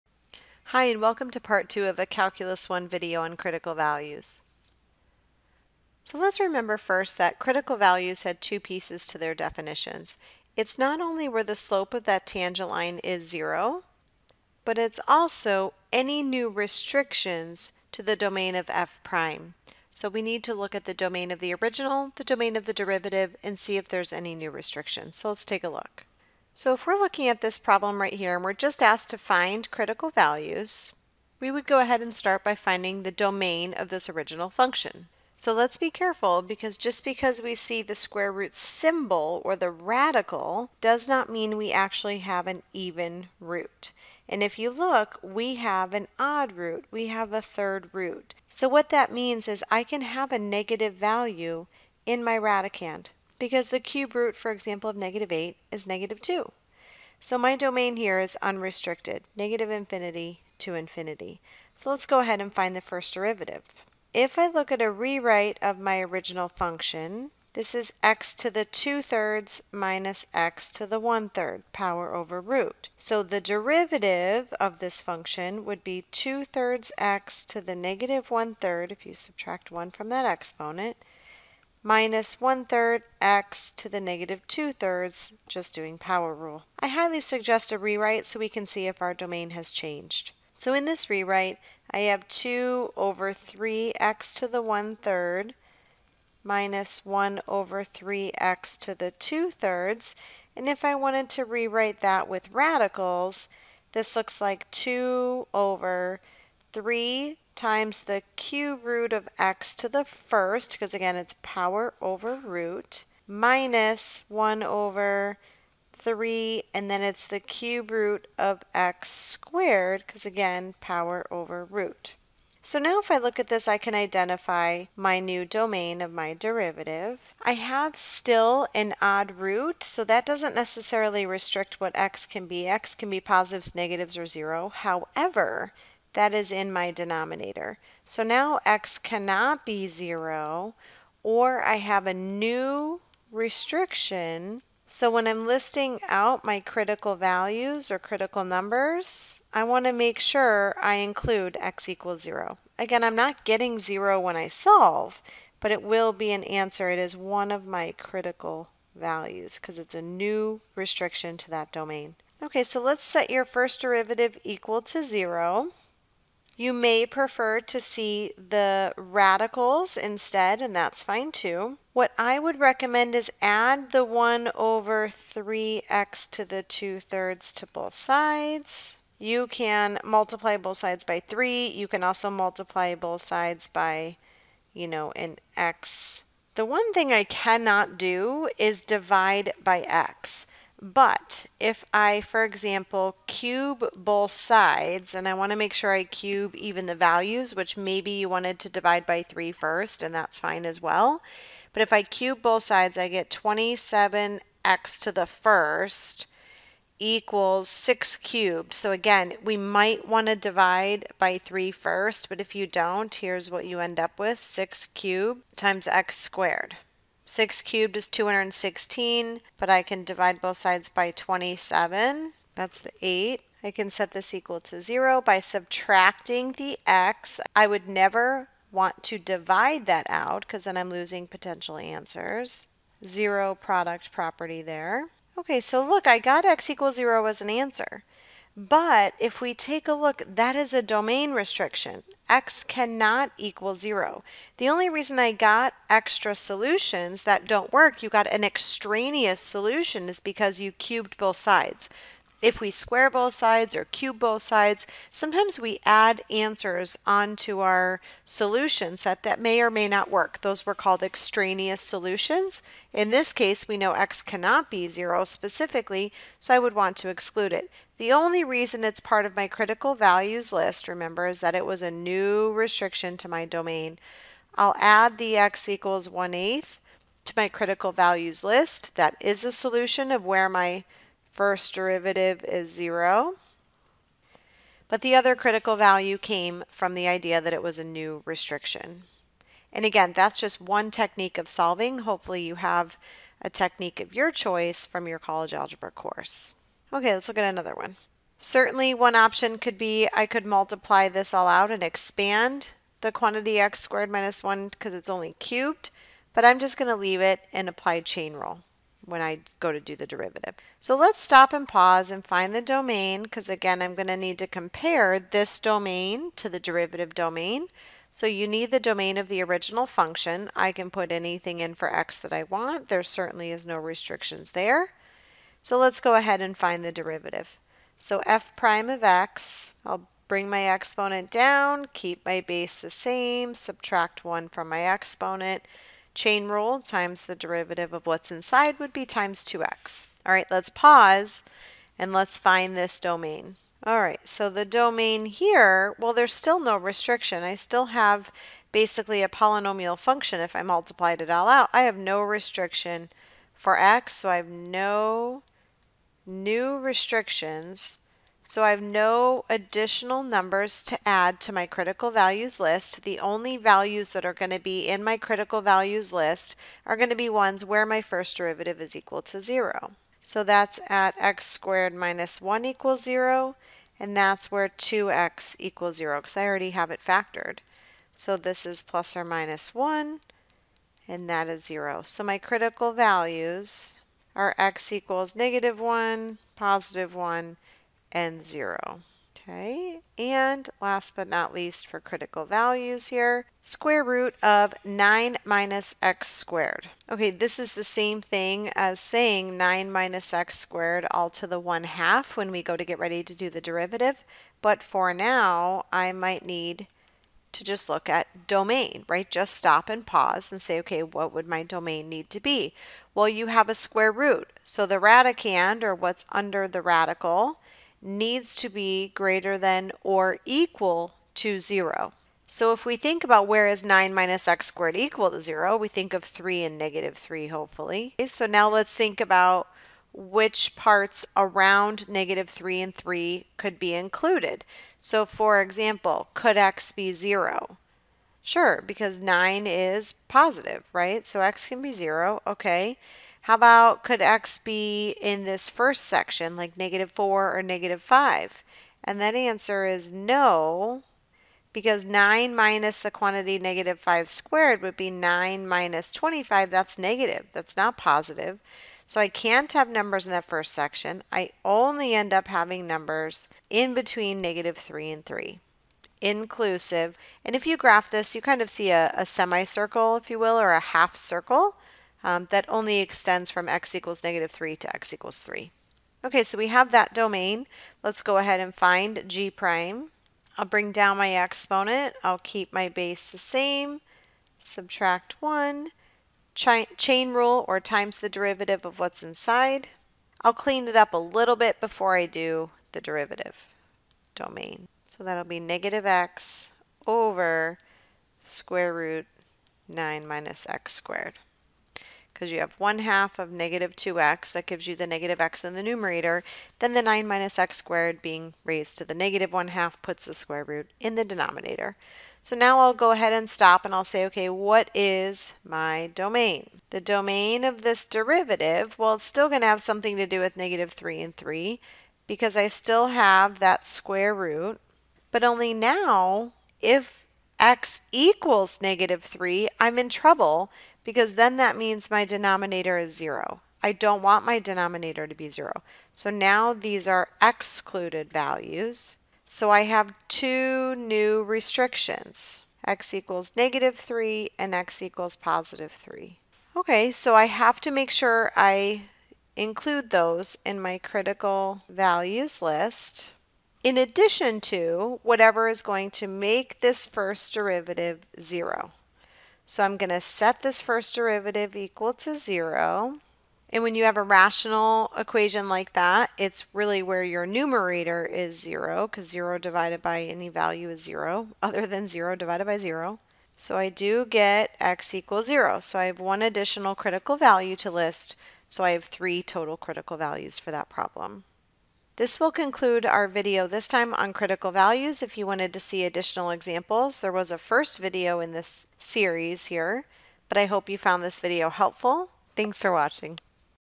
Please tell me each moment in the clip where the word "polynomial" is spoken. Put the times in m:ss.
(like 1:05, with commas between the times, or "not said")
5:49.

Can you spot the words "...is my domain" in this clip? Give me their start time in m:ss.
8:34.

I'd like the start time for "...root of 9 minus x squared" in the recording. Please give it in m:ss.
6:34.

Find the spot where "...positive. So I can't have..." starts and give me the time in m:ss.
7:37.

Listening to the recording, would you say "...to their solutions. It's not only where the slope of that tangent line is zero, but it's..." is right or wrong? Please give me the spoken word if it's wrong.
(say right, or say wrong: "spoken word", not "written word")
wrong: "definitions", not "solutions".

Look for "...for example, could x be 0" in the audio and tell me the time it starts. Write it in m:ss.
7:15.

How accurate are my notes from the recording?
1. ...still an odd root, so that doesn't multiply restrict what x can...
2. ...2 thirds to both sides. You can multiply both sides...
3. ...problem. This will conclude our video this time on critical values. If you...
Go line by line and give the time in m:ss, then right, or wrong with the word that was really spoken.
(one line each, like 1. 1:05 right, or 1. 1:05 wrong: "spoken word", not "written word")
1. 2:07 wrong: "necessarily", not "multiply"
2. 2:56 right
3. 9:40 right.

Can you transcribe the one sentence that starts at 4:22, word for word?
In this case, we know x cannot be 0 specifically, so I would want to exclude it.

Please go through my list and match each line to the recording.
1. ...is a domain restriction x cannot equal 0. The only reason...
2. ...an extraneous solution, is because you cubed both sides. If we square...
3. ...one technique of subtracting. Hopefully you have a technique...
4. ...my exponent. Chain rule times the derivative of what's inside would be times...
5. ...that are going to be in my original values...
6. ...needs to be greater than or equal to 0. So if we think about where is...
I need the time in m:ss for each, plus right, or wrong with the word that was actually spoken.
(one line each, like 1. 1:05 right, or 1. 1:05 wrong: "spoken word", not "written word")
1. 4:00 right
2. 4:08 right
3. 4:50 wrong: "solving", not "subtracting"
4. 5:34 right
5. 6:04 wrong: "critical", not "original"
6. 6:58 right.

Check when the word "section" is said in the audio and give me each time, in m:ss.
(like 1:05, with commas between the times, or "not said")
7:26, 7:40.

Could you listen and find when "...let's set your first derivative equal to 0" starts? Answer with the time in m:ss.
2:42.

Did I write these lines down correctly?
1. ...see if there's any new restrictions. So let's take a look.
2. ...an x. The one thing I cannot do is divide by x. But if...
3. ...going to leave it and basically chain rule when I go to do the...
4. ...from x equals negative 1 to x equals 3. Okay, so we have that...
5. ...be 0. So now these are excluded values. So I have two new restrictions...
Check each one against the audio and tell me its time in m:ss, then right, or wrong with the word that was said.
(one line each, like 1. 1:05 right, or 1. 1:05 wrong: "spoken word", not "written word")
1. 0:23 right
2. 3:05 right
3. 5:06 wrong: "apply", not "basically"
4. 7:53 wrong: "3", not "1"
5. 8:55 right.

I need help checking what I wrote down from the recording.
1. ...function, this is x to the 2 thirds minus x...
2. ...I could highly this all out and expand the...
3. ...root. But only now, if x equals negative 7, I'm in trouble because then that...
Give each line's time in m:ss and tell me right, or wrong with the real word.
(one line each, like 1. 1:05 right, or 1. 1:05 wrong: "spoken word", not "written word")
1. 1:06 right
2. 5:00 wrong: "multiply", not "highly"
3. 8:44 wrong: "3", not "7".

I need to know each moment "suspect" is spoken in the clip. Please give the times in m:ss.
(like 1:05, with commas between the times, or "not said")
not said.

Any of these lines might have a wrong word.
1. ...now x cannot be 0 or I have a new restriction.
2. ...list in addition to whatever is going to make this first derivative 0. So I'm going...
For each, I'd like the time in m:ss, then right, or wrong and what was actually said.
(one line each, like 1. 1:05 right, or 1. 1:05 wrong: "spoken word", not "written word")
1. 2:18 right
2. 9:12 right.